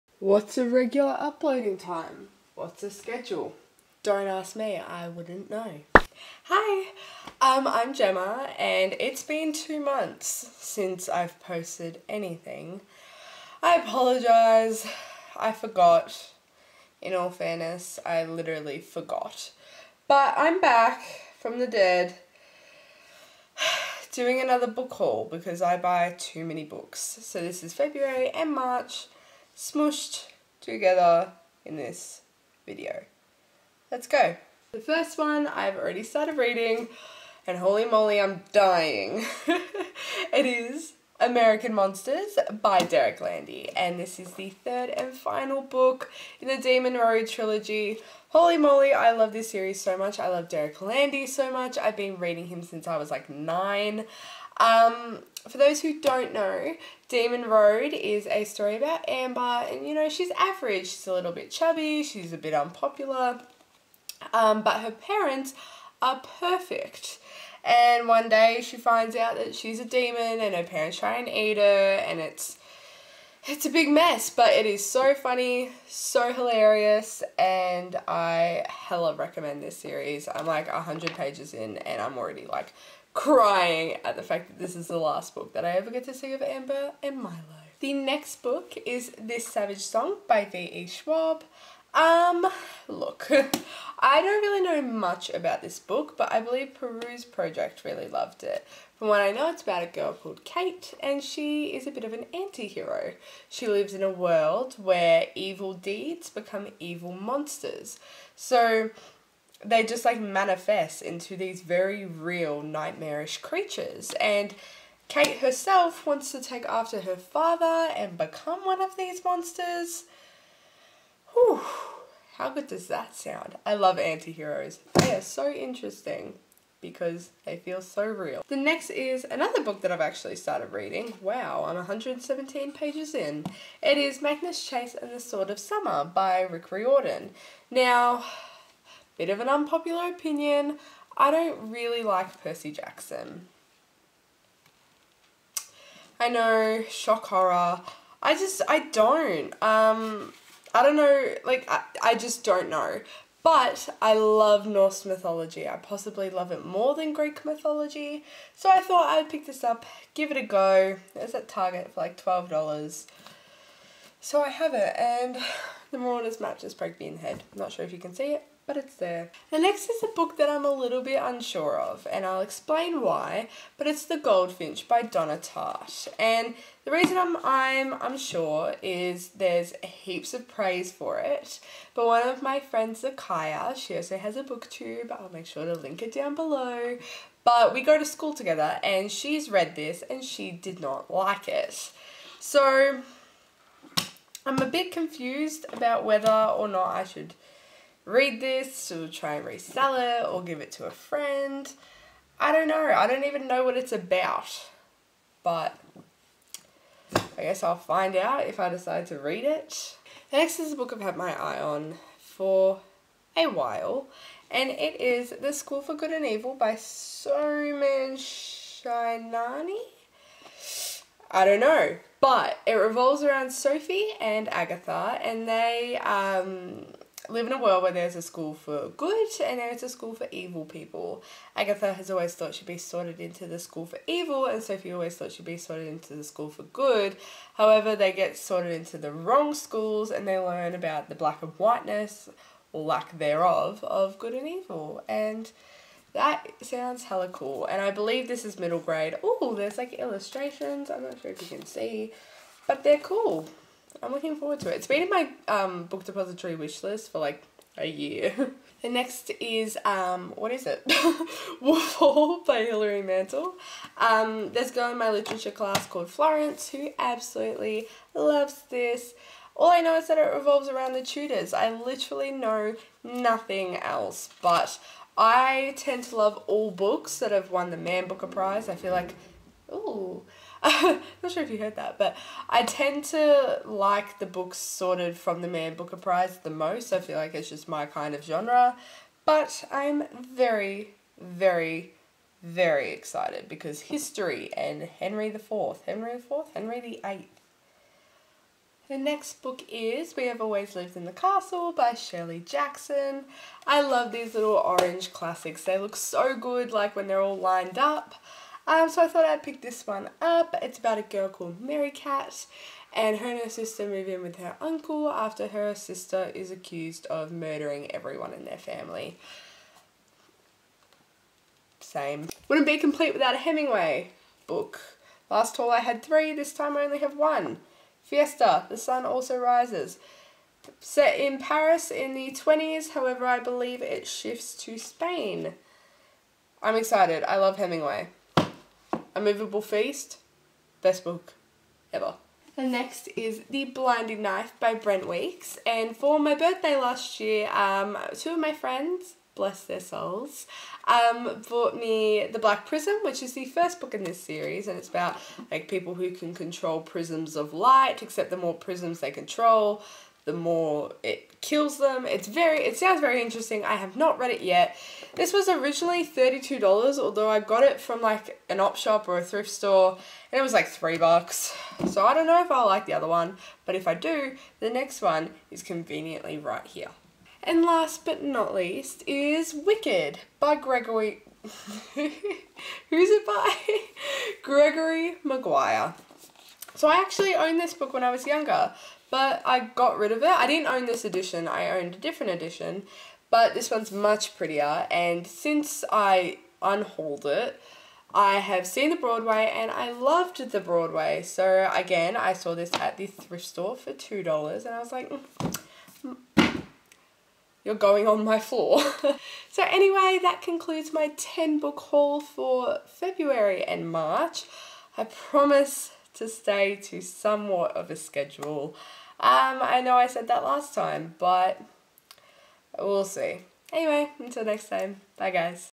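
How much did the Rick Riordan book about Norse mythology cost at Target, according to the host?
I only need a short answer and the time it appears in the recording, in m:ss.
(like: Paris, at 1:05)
$12, at 2:42.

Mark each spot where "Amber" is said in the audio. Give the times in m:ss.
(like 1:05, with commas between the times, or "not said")
0:59, 1:26.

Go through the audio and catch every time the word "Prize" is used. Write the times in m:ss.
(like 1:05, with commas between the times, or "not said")
4:38, 4:45.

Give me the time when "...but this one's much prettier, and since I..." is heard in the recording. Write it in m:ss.
6:33.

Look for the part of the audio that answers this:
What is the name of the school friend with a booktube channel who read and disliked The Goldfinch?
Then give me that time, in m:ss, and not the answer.
3:03.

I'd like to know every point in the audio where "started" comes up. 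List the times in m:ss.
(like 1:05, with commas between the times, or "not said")
0:36, 2:10.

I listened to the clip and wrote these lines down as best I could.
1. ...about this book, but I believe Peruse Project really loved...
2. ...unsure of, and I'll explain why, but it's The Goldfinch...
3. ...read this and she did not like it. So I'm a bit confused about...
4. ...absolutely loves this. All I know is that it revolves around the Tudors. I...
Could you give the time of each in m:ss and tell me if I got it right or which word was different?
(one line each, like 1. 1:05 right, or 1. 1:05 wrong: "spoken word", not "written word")
1. 1:35 right
2. 2:51 right
3. 3:09 right
4. 4:26 right.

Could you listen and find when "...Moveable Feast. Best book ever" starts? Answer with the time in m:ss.
5:39.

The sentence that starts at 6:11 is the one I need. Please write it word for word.
So I don't know if I'll like the other one, but if I do, the next one is conveniently right here.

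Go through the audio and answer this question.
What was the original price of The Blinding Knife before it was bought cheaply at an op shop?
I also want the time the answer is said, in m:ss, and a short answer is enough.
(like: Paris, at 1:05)
$32, at 6:06.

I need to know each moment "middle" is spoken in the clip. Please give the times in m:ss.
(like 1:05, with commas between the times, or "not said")
4:08.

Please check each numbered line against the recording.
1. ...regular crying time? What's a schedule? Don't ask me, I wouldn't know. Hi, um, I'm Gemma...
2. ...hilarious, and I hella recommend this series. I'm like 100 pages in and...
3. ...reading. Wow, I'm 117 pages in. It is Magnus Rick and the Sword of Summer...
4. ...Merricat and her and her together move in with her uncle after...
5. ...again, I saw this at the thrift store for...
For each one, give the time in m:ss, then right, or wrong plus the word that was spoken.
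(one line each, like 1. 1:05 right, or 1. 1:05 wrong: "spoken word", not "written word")
1. 0:00 wrong: "uploading", not "crying"
2. 1:16 right
3. 2:10 wrong: "Chase", not "Rick"
4. 5:11 wrong: "sister", not "together"
5. 6:41 right.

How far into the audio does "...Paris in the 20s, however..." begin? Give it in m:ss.
5:31.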